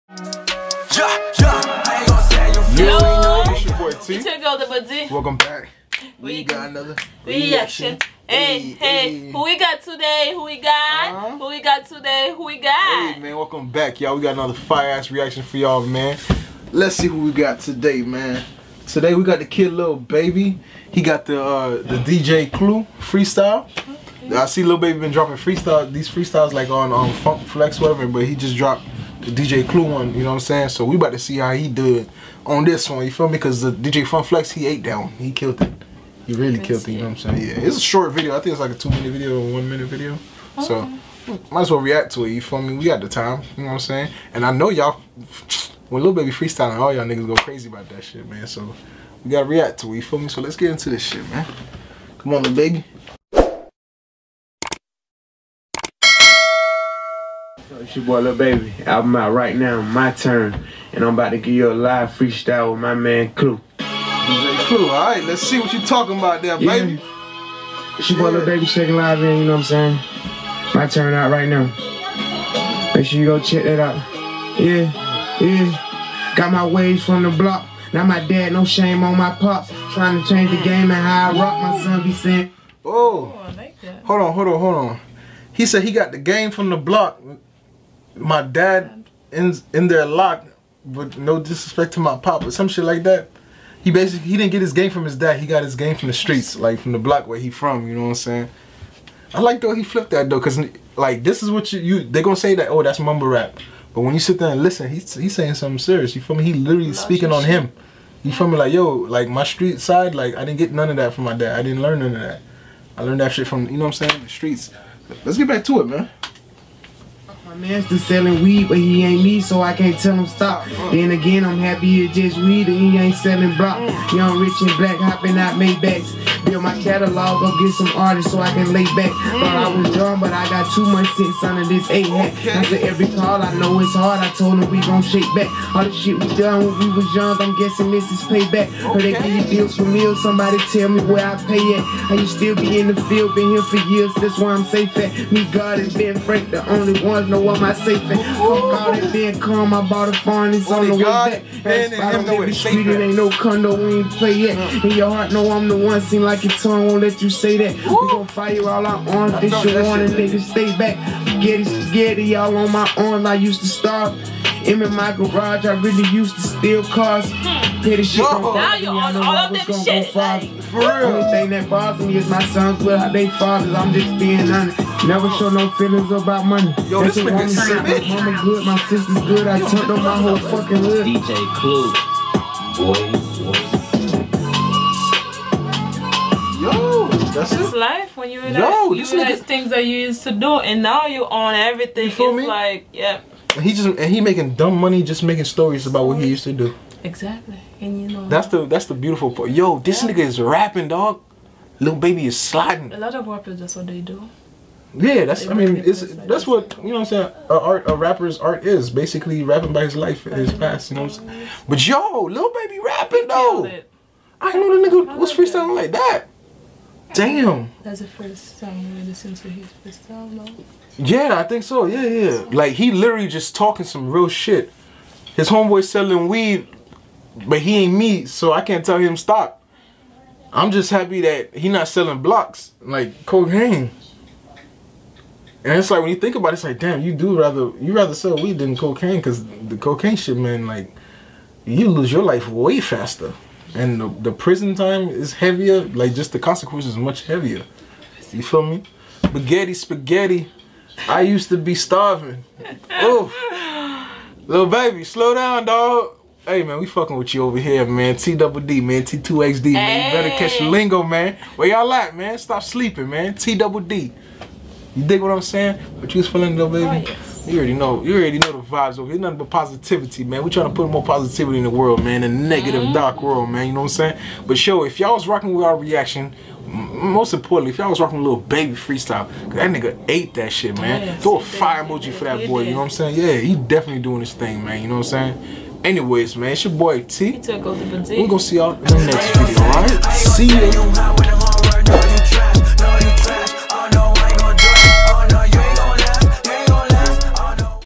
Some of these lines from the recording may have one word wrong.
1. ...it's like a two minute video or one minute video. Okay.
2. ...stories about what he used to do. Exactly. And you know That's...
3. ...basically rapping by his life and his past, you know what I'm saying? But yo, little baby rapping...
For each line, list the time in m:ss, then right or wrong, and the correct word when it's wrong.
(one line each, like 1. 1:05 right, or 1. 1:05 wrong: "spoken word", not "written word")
1. 0:38 right
2. 3:15 right
3. 3:28 right.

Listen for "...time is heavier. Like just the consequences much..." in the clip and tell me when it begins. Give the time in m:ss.
4:04.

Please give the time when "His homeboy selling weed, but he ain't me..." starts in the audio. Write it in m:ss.
3:45.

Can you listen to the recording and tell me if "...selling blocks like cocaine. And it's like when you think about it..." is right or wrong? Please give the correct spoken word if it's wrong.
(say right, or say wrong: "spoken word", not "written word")
right.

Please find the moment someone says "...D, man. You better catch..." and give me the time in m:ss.
4:19.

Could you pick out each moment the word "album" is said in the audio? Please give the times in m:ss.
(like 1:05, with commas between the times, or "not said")
0:58, 3:40.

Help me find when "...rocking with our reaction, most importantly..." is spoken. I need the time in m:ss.
4:35.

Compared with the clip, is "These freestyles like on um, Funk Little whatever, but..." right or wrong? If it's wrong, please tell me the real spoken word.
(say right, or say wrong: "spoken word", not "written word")
wrong: "Flex", not "Little".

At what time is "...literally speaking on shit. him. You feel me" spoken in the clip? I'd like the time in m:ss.
1:46.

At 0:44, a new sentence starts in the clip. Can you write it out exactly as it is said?
And I know y'all, when Lil Baby freestyling, all y'all niggas go crazy about that shit, man.